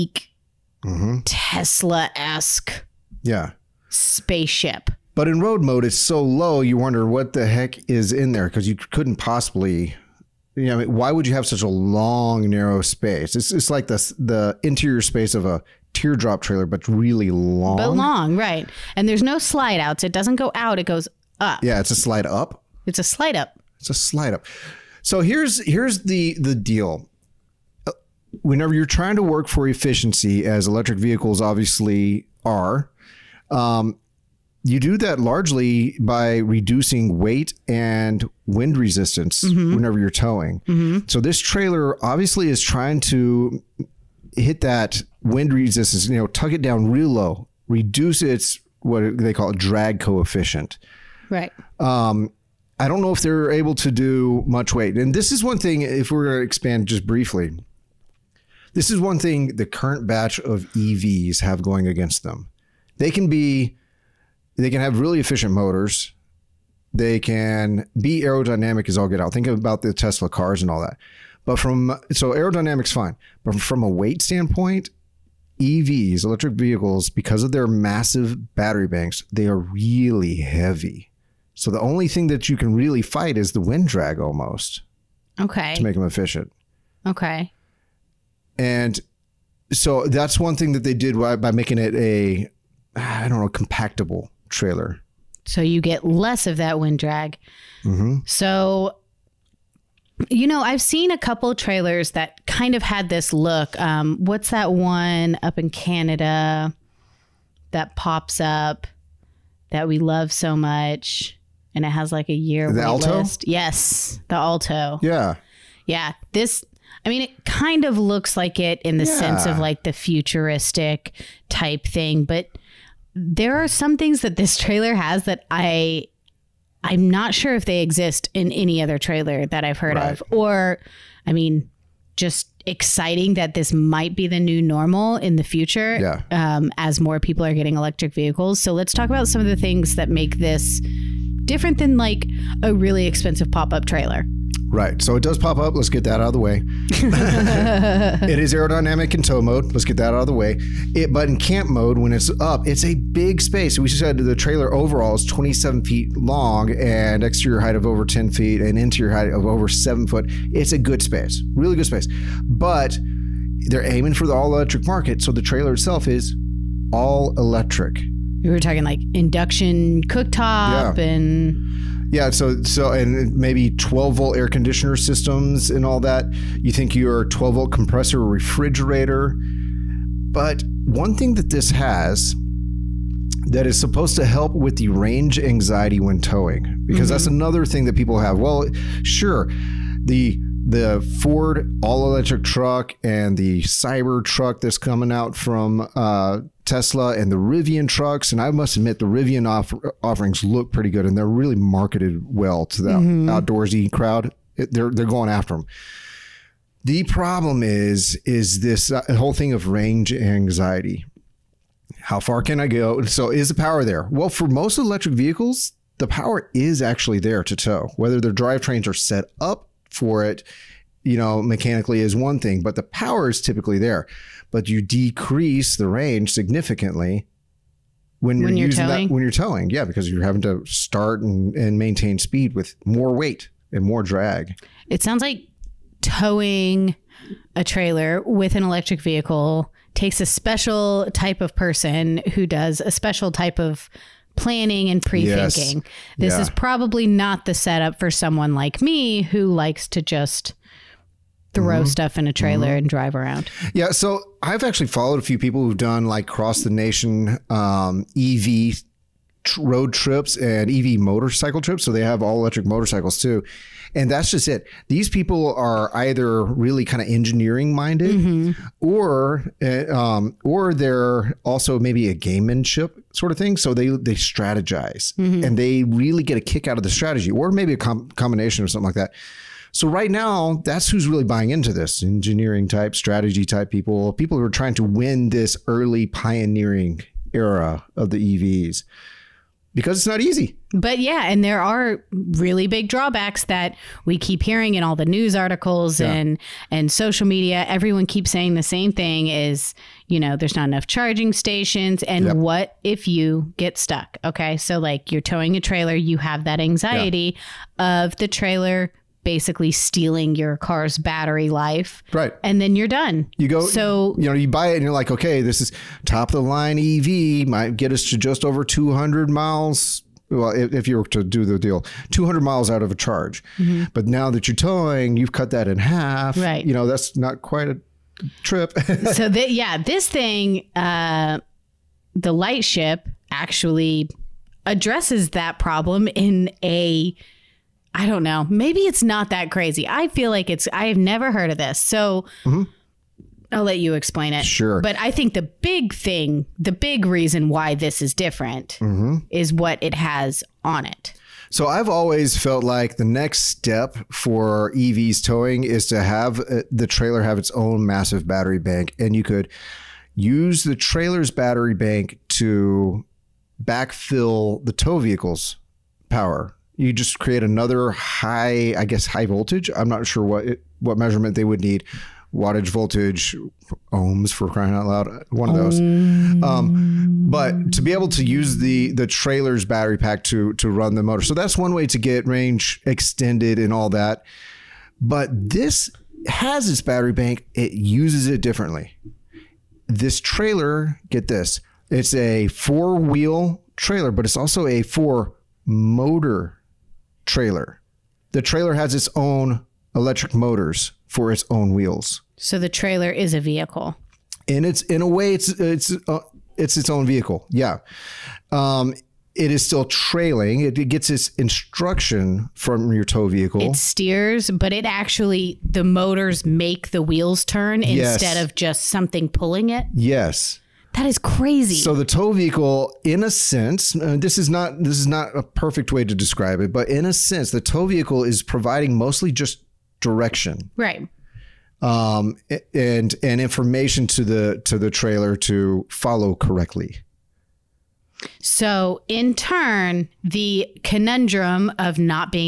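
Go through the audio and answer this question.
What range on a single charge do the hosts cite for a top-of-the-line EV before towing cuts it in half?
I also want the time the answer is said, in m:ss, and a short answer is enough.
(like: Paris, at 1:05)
200 miles, at 5:22.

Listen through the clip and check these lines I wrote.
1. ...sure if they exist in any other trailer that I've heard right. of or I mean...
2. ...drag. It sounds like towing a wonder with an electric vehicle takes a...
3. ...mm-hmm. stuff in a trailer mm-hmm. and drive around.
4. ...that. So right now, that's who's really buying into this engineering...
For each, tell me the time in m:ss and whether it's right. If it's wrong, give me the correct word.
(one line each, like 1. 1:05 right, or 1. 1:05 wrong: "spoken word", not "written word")
1. 2:07 right
2. 3:54 wrong: "trailer", not "wonder"
3. 4:11 right
4. 4:38 right.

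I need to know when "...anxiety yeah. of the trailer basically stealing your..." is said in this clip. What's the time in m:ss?
5:06.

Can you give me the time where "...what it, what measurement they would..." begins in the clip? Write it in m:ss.
6:10.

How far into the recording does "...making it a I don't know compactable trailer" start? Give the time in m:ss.
1:31.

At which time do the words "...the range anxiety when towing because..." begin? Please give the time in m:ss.
3:04.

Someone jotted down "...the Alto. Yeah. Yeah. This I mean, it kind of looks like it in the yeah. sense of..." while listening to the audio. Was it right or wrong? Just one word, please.
right.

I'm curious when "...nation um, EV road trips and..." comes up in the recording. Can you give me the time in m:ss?
4:16.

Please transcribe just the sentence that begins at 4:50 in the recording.
But yeah, and there are really big drawbacks that we keep hearing in all the news articles yeah.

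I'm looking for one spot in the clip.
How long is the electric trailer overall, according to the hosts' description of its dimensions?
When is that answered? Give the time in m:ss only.
2:35.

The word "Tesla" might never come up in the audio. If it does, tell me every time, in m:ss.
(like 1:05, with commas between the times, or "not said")
0:01, 1:09, 3:16.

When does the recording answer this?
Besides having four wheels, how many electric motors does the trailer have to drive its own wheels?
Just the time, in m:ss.
6:34.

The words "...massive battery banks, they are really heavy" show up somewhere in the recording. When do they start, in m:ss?
1:17.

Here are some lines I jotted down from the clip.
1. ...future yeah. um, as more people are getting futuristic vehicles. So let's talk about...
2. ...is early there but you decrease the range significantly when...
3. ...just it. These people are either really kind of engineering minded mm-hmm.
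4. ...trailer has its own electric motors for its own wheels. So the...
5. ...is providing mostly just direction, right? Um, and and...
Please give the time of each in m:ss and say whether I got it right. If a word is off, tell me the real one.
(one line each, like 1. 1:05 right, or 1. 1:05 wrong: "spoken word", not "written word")
1. 2:15 wrong: "electric", not "futuristic"
2. 3:43 wrong: "typically", not "early"
3. 4:24 right
4. 6:38 right
5. 7:08 right.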